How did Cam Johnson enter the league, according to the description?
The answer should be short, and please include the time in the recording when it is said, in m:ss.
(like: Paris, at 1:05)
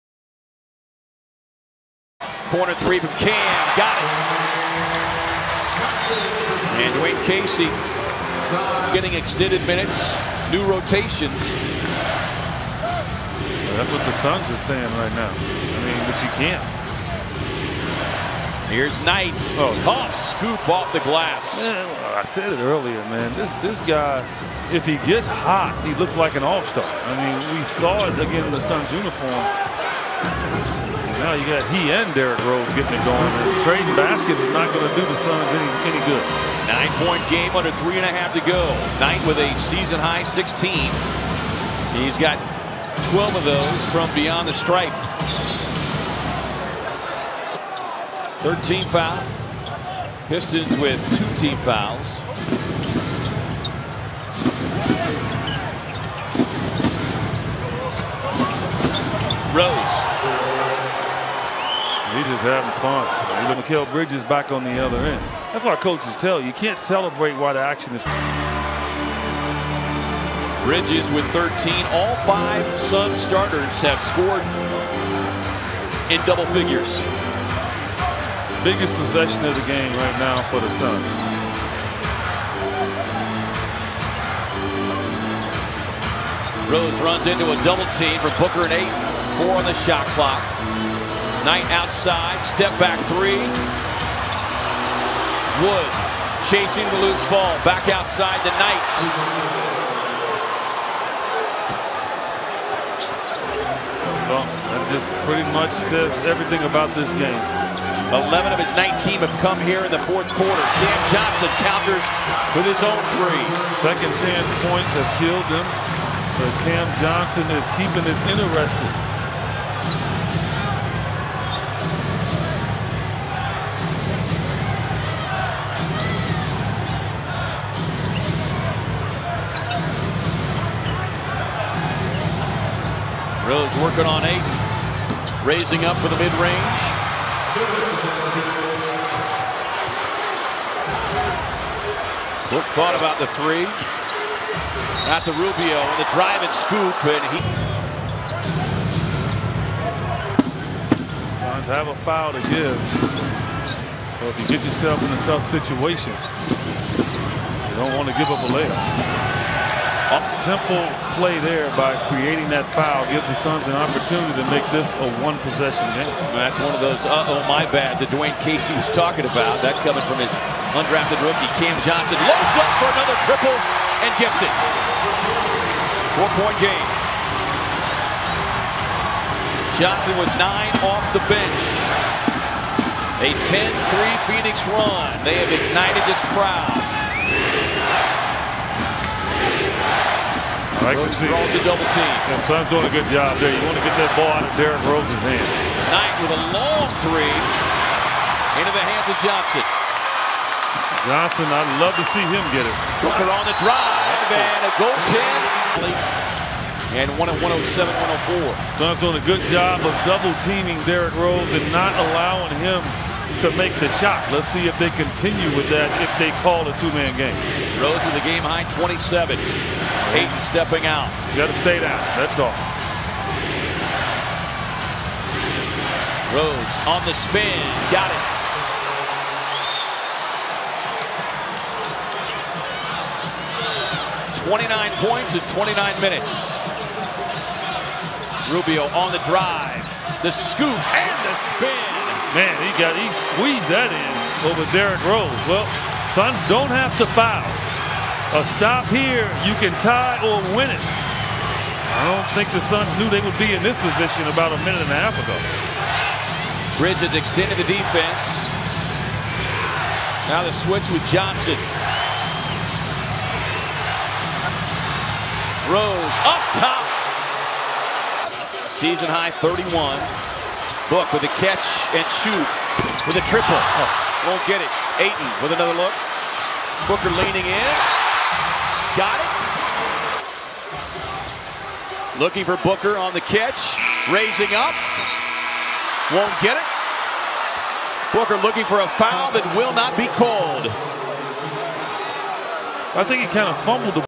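Undrafted rookie, at 2:50.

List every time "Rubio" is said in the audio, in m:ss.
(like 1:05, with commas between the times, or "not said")
2:25, 3:58.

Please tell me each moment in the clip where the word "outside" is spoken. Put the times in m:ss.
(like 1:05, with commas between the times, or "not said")
1:31, 1:37.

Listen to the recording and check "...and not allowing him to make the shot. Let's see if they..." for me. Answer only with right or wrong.
right.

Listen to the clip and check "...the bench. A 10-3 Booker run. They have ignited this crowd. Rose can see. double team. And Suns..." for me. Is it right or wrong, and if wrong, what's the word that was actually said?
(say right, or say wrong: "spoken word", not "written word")
wrong: "Phoenix", not "Booker".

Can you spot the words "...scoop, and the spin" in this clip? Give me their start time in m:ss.
4:00.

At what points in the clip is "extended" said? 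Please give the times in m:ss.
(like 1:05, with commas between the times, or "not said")
0:09, 4:17.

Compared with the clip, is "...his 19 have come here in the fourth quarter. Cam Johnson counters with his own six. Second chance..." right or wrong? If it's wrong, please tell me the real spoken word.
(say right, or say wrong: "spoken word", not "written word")
wrong: "three", not "six".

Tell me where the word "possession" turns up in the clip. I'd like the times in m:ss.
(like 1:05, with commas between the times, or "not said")
1:18, 2:45.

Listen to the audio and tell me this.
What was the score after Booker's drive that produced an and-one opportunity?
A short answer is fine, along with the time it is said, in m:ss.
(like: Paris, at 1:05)
107-104, at 3:27.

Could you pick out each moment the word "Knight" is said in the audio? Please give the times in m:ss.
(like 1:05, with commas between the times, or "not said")
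0:19, 0:38, 1:31, 1:38, 3:15.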